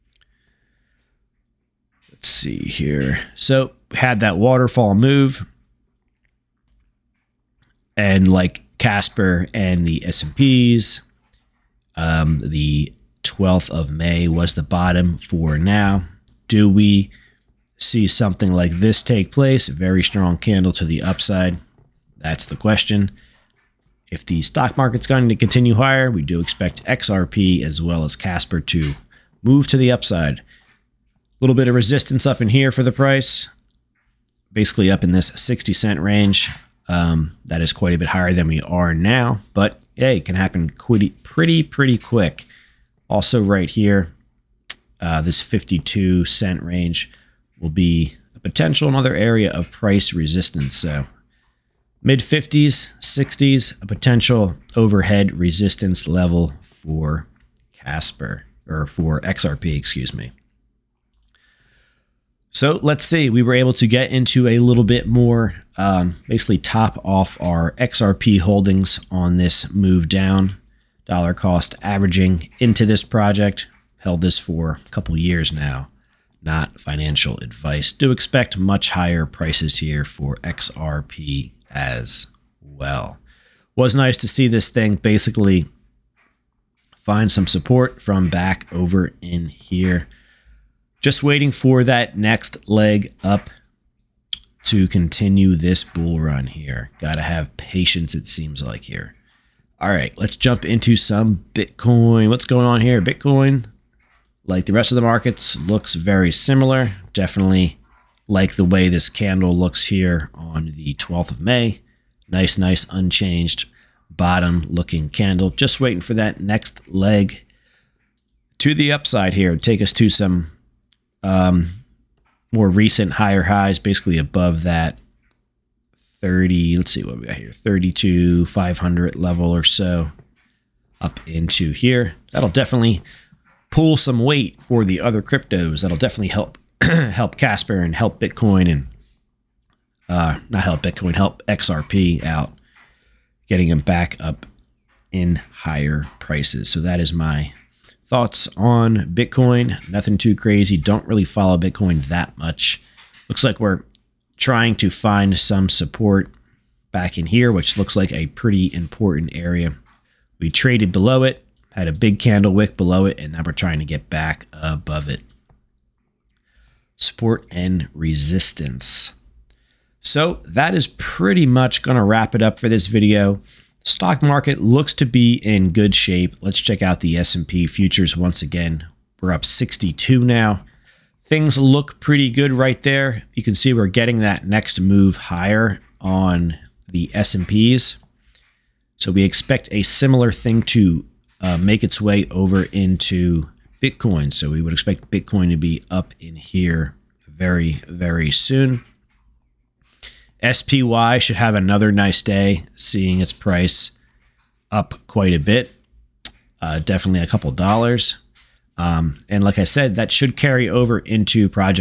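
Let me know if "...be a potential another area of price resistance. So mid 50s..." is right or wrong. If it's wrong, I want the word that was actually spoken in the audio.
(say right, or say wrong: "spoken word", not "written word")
right.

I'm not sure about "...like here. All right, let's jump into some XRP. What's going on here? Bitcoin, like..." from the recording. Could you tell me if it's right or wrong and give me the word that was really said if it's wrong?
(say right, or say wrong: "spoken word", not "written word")
wrong: "Bitcoin", not "XRP".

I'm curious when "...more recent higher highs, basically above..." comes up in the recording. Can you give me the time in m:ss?
2:02.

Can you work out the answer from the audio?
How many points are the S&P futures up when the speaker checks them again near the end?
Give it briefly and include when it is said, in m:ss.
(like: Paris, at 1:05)
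62, at 2:59.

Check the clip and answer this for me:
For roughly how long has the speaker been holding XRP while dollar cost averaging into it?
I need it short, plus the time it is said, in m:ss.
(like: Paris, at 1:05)
a couple years, at 1:14.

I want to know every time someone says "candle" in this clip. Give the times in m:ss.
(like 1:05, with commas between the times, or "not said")
0:20, 1:49, 1:55, 2:42.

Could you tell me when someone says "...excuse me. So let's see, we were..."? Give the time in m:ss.
0:59.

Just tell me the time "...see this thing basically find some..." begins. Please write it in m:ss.
1:24.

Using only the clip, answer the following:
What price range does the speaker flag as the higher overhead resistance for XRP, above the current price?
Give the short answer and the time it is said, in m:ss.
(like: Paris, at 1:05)
60 cents, at 0:35.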